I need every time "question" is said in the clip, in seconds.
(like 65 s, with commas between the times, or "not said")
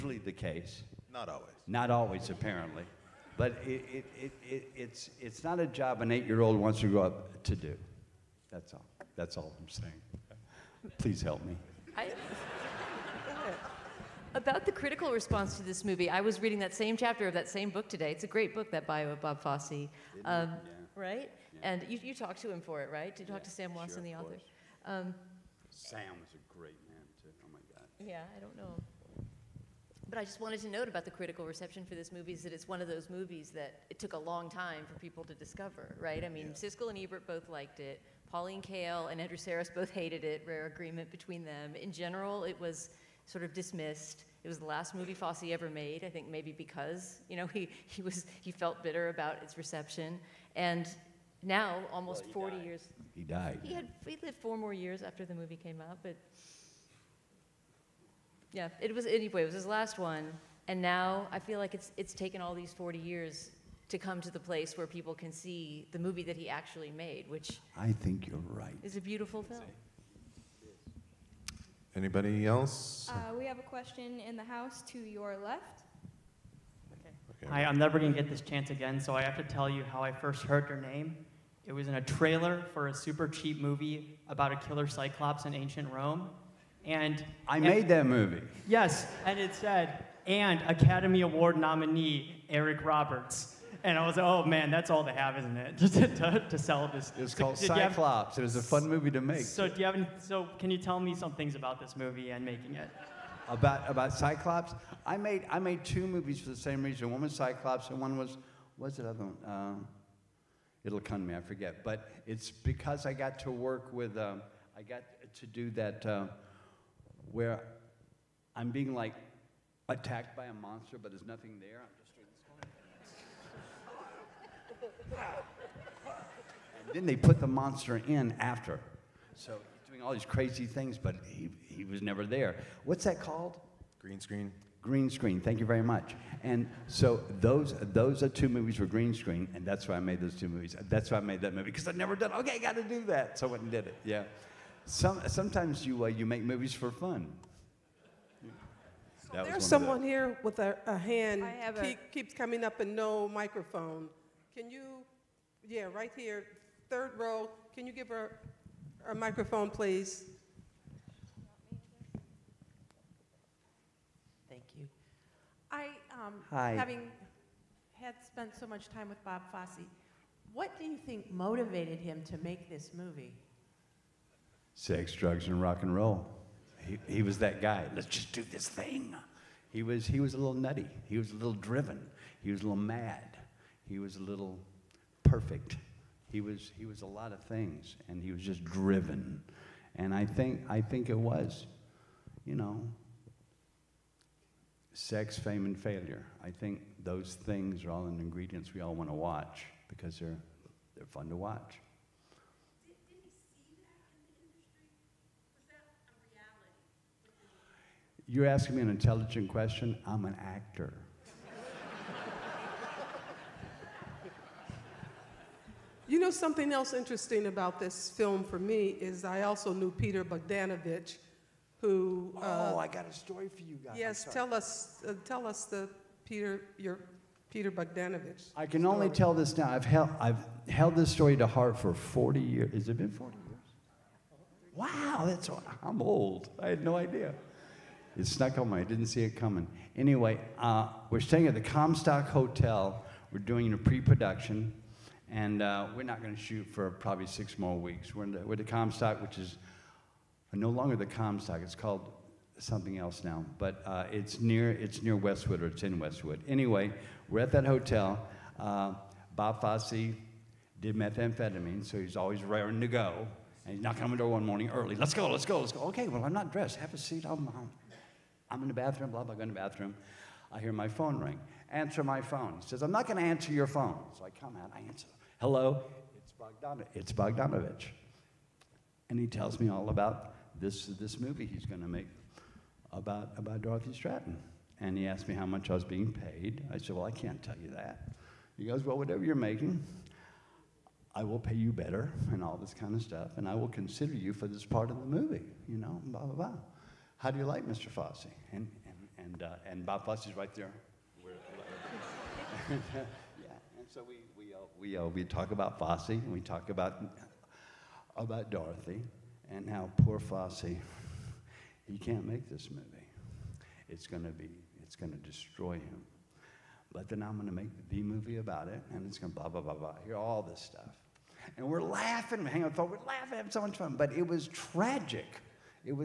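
73 s, 209 s.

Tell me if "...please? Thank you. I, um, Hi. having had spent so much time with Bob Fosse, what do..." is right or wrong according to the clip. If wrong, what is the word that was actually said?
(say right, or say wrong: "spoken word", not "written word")
right.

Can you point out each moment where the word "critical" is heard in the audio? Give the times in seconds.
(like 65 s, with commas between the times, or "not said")
14 s, 31 s.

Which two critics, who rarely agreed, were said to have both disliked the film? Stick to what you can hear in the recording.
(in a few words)
Pauline Kael and Andrew Sarris.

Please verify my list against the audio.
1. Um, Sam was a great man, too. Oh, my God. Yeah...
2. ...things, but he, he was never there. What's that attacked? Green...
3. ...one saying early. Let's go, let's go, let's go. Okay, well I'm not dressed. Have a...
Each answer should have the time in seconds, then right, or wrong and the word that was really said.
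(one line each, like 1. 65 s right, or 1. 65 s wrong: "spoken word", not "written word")
1. 24 s right
2. 130 s wrong: "called", not "attacked"
3. 264 s wrong: "morning", not "saying".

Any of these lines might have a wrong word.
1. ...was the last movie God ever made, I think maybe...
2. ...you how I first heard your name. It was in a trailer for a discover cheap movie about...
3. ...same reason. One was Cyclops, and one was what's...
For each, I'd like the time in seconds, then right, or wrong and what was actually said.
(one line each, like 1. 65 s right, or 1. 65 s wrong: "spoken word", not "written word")
1. 44 s wrong: "Fosse", not "God"
2. 79 s wrong: "super", not "discover"
3. 106 s right.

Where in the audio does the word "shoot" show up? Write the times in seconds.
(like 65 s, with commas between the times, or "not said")
246 s.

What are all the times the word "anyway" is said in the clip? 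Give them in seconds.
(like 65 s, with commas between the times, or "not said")
59 s, 239 s, 256 s.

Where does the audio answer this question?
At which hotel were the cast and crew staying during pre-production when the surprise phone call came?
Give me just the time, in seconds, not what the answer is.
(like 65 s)
241 s.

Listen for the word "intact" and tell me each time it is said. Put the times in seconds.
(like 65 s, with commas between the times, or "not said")
not said.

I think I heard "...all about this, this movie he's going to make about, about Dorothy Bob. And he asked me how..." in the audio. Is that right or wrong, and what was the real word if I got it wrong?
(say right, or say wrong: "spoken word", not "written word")
wrong: "Stratten", not "Bob".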